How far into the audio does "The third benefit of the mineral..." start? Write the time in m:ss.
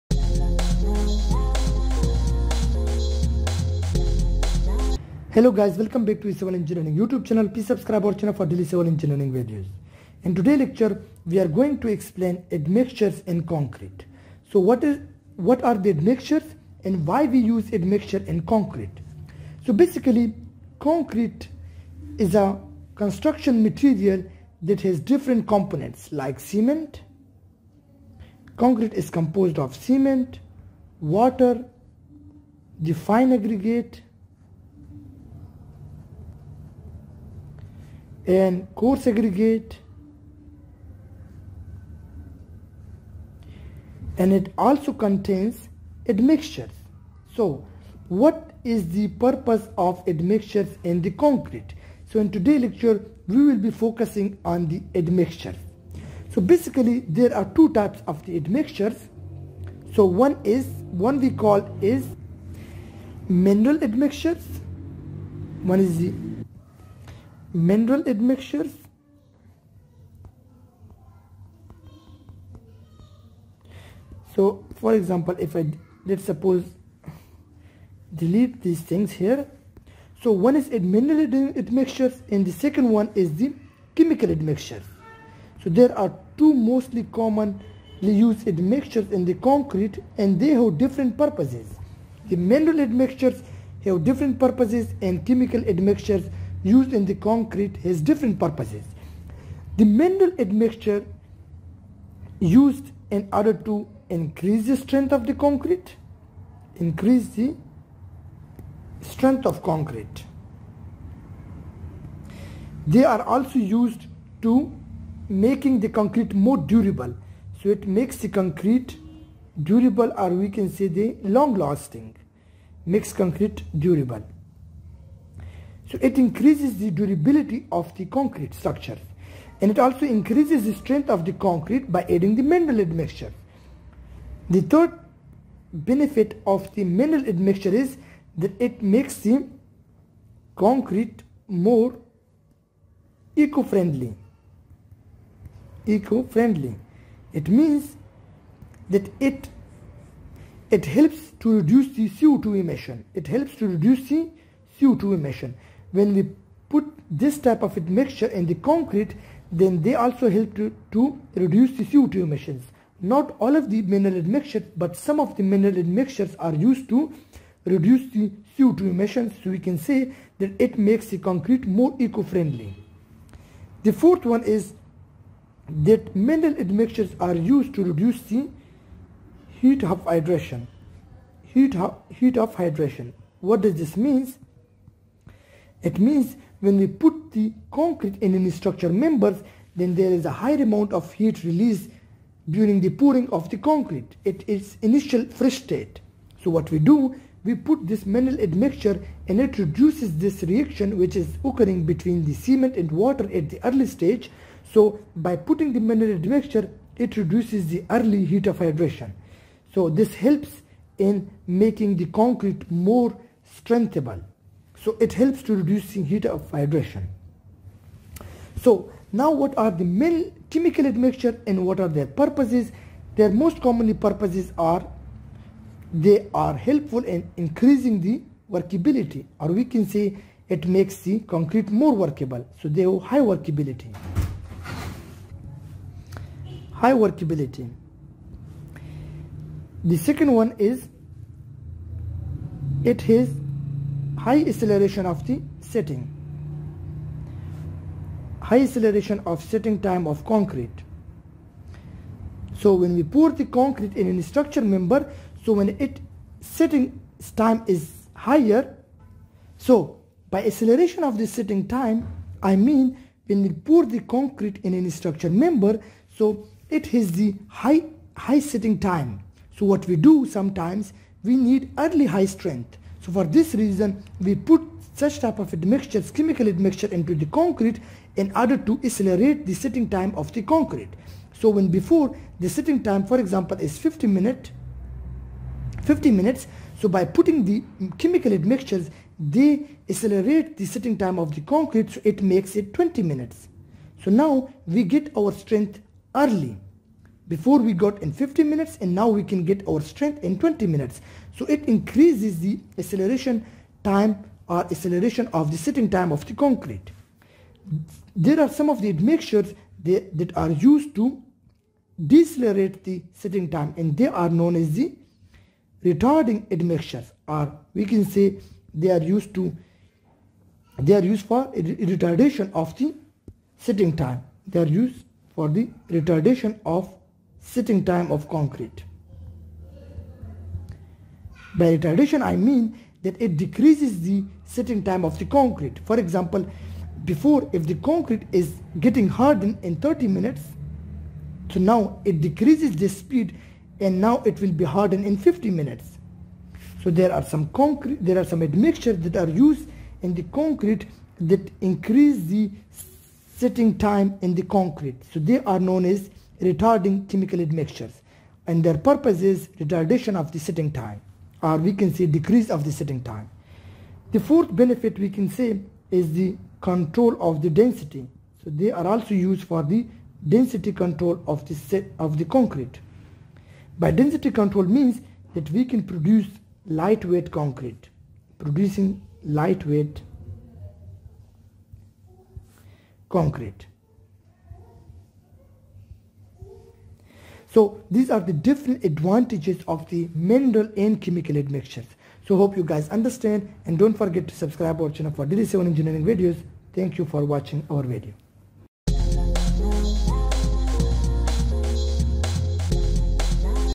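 2:14.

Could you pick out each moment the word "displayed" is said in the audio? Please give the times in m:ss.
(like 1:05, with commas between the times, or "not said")
not said.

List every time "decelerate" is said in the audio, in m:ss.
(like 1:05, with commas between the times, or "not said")
5:12.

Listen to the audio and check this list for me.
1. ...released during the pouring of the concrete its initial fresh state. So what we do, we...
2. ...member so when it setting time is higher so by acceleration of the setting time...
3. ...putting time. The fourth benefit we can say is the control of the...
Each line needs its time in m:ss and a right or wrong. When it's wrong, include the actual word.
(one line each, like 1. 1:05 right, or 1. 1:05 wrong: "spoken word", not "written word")
1. 3:11 right
2. 4:14 right
3. 6:02 wrong: "setting", not "putting".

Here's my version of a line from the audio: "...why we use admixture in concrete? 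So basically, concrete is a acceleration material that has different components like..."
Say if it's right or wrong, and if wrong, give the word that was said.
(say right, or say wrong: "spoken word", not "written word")
wrong: "construction", not "acceleration".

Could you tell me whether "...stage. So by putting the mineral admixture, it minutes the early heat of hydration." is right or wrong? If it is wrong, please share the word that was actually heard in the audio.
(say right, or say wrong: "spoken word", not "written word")
wrong: "reduces", not "minutes".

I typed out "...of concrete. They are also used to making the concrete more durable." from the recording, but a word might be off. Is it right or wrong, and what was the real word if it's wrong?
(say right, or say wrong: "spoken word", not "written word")
right.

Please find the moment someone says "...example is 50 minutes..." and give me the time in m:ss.
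4:43.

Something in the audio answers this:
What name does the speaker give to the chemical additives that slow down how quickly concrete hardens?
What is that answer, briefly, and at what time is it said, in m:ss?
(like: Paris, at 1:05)
Retarding admixtures, at 5:15.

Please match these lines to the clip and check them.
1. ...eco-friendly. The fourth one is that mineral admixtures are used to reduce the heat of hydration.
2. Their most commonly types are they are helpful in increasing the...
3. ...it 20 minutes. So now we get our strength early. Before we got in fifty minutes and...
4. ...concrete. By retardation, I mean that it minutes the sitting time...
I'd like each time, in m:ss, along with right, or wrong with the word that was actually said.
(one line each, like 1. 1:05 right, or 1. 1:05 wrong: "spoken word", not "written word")
1. 2:51 right
2. 3:43 wrong: "purposes", not "types"
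3. 4:52 right
4. 5:28 wrong: "decreases", not "minutes".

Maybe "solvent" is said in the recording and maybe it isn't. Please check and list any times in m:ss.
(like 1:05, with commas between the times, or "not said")
not said.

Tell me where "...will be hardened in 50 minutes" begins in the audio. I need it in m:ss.
5:44.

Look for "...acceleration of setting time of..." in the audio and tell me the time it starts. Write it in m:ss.
4:08.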